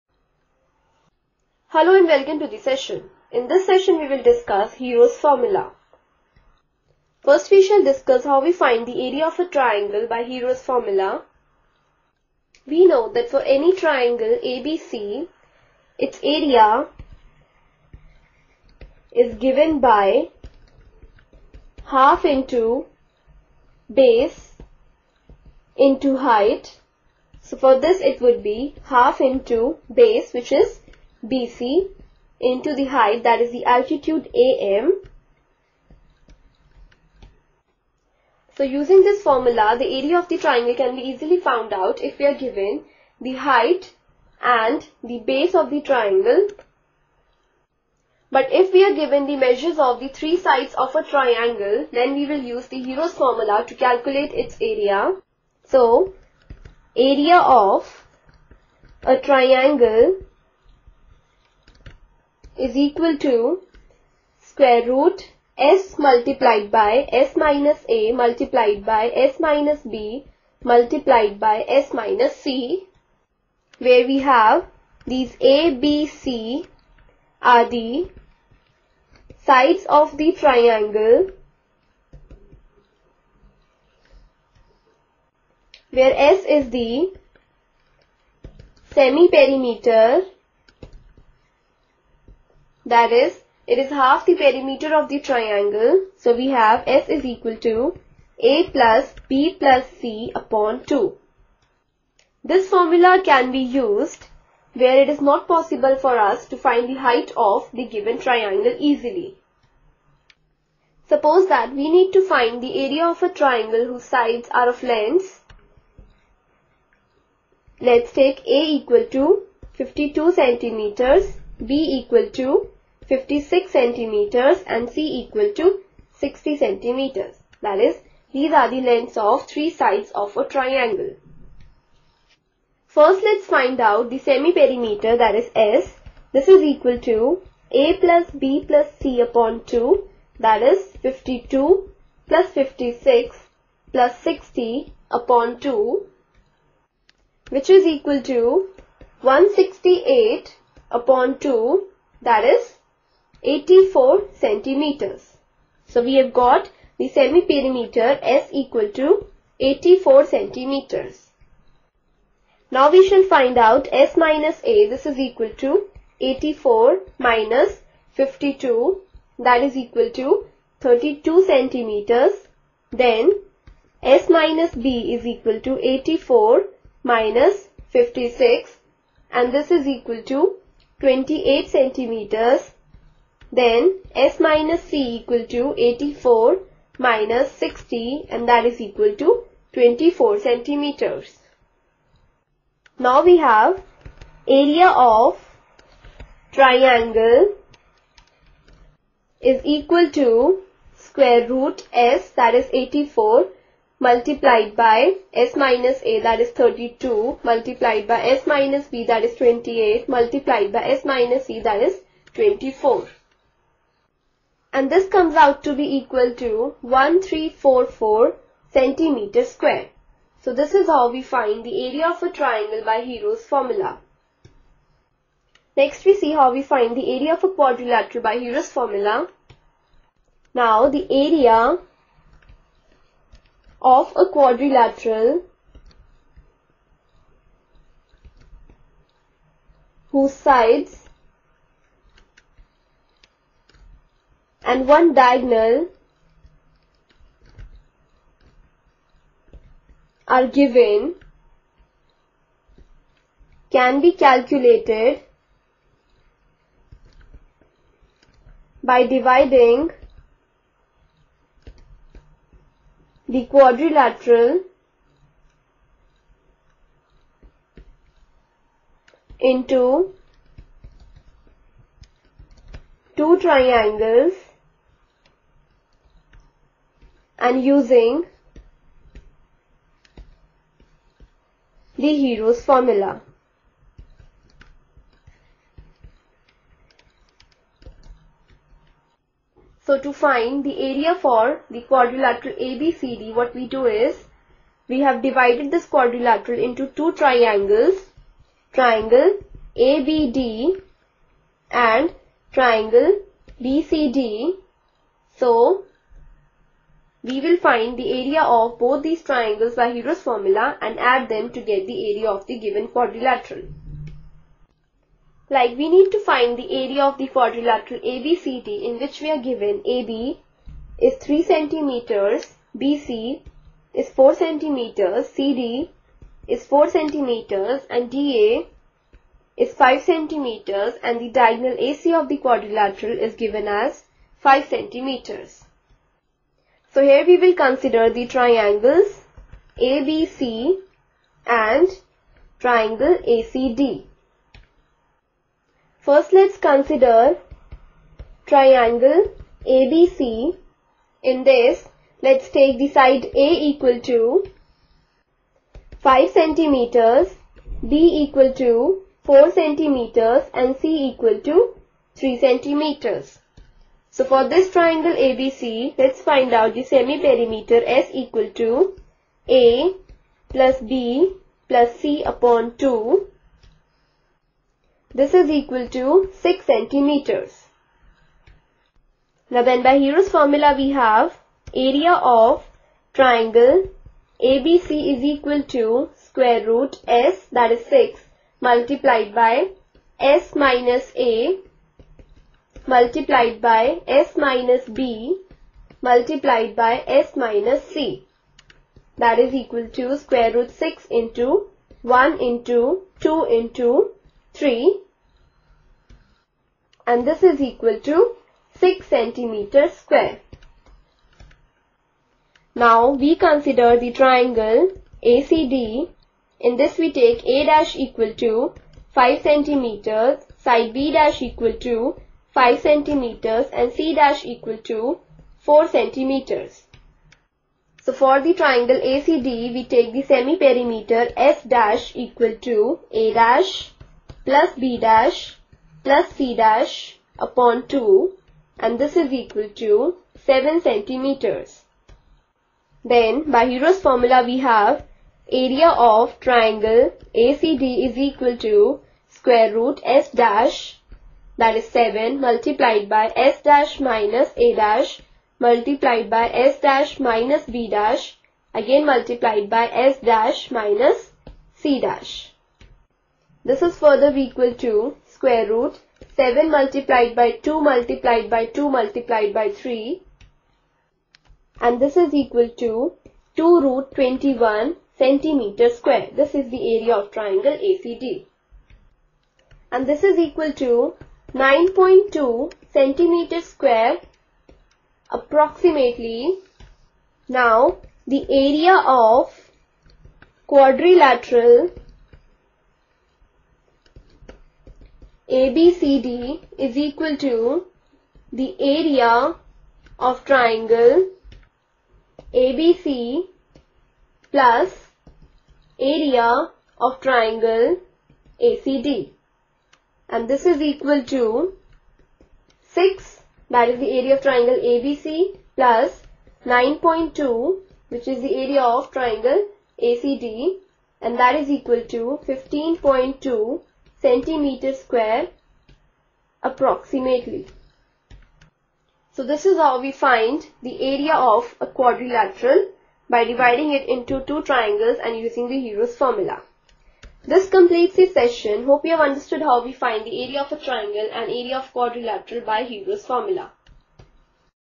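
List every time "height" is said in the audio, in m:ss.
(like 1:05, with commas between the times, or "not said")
0:26, 0:32, 0:43, 1:46.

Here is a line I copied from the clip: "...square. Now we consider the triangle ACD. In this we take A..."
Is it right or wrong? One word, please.
right.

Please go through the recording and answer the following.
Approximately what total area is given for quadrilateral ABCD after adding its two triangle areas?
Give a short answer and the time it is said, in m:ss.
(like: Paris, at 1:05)
15.2 square centimeters, at 8:42.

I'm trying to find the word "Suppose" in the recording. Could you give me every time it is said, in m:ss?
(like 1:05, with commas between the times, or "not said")
1:51.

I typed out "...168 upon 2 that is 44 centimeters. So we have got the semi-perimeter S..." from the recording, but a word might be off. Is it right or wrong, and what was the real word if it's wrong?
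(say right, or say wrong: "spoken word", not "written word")
wrong: "84", not "44".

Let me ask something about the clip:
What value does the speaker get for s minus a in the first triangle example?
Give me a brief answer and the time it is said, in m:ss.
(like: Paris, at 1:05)
32 centimeters, at 2:50.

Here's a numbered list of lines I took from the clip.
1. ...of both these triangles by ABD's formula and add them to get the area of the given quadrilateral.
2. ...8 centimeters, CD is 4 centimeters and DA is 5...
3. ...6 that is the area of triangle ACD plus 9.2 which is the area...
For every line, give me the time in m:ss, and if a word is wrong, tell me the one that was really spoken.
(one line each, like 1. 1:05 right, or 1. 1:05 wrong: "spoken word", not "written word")
1. 5:08 wrong: "Hero", not "ABD"
2. 5:24 wrong: "4", not "8"
3. 8:32 wrong: "ABC", not "ACD".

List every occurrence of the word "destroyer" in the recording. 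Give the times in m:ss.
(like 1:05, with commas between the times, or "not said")
not said.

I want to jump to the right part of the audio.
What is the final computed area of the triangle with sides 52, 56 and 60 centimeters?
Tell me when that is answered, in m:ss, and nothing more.
3:36.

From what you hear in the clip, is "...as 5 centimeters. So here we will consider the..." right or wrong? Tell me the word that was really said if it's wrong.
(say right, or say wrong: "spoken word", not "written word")
right.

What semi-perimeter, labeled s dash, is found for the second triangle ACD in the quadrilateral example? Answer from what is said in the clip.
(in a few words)
7 centimeters.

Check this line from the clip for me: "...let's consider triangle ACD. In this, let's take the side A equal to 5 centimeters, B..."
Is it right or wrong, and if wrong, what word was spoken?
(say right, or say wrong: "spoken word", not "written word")
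wrong: "ABC", not "ACD".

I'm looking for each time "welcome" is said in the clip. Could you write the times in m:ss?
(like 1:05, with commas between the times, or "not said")
0:02.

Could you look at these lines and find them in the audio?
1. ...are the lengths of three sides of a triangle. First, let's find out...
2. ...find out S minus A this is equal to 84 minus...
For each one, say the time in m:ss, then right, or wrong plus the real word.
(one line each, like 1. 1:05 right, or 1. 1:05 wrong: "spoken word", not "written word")
1. 2:08 right
2. 2:43 right.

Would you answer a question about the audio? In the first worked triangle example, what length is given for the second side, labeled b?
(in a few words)
56 centimeters.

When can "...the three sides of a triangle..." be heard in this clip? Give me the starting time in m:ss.
0:49.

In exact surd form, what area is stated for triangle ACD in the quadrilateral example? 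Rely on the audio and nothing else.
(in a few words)
2√21 square centimeters.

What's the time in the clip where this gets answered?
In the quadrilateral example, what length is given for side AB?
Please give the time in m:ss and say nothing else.
5:19.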